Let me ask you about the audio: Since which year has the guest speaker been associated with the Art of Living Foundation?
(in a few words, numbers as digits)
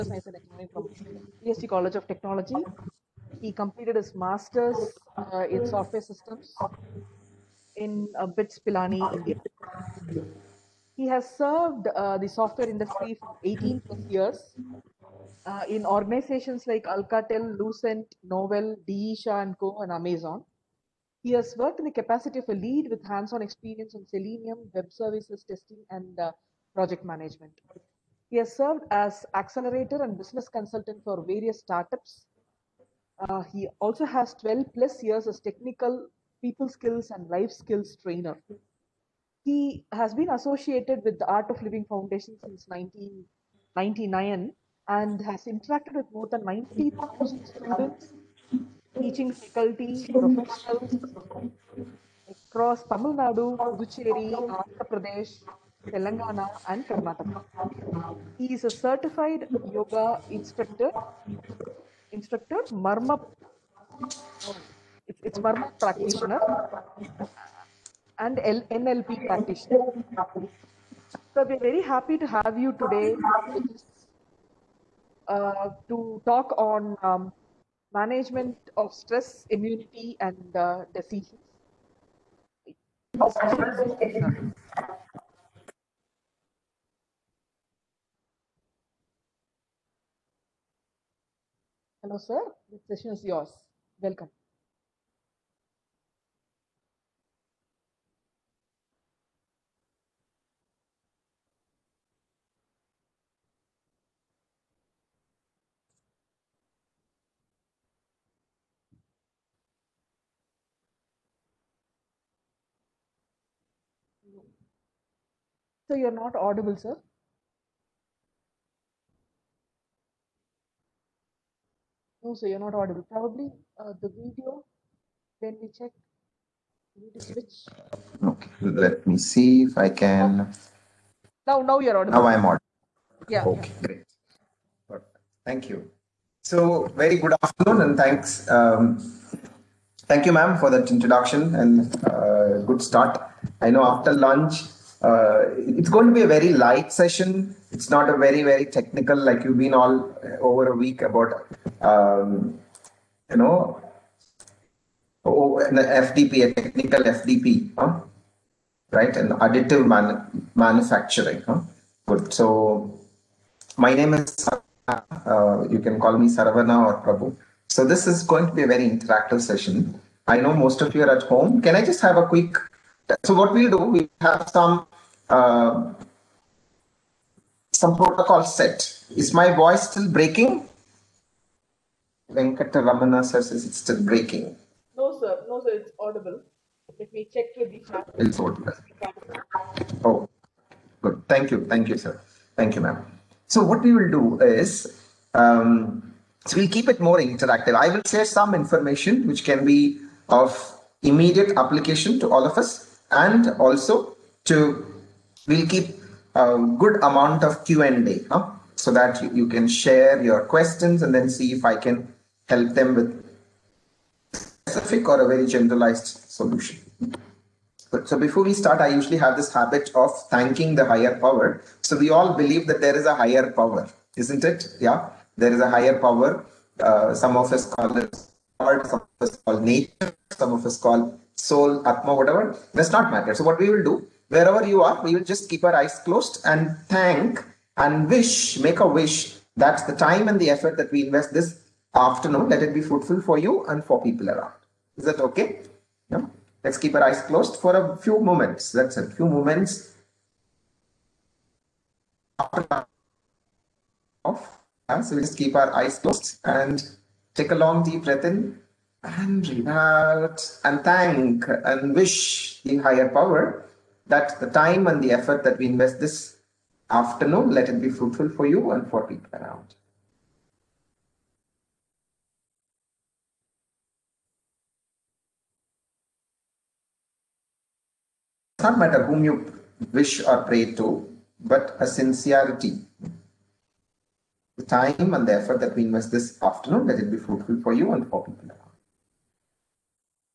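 1999.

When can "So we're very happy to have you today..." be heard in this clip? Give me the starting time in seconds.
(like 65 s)
71 s.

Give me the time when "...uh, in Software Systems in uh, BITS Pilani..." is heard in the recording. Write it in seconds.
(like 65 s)
5 s.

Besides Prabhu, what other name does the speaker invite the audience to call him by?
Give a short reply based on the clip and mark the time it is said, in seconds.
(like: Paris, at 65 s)
Saravana, at 166 s.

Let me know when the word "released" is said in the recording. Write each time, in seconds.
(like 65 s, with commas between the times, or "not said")
not said.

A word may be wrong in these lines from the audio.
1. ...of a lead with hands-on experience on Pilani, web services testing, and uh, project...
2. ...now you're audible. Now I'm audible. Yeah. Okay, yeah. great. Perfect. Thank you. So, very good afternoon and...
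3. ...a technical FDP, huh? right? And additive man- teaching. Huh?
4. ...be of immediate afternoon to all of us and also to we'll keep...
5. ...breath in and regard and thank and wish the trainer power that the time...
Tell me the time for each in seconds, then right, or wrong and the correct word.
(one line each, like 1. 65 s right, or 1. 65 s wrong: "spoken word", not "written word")
1. 22 s wrong: "Selenium", not "Pilani"
2. 131 s right
3. 156 s wrong: "manufacturing", not "teaching"
4. 199 s wrong: "application", not "afternoon"
5. 258 s wrong: "higher", not "trainer".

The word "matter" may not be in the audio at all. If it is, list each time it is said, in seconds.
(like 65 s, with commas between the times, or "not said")
233 s, 278 s.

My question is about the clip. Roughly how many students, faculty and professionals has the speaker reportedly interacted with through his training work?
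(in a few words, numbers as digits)
90,000.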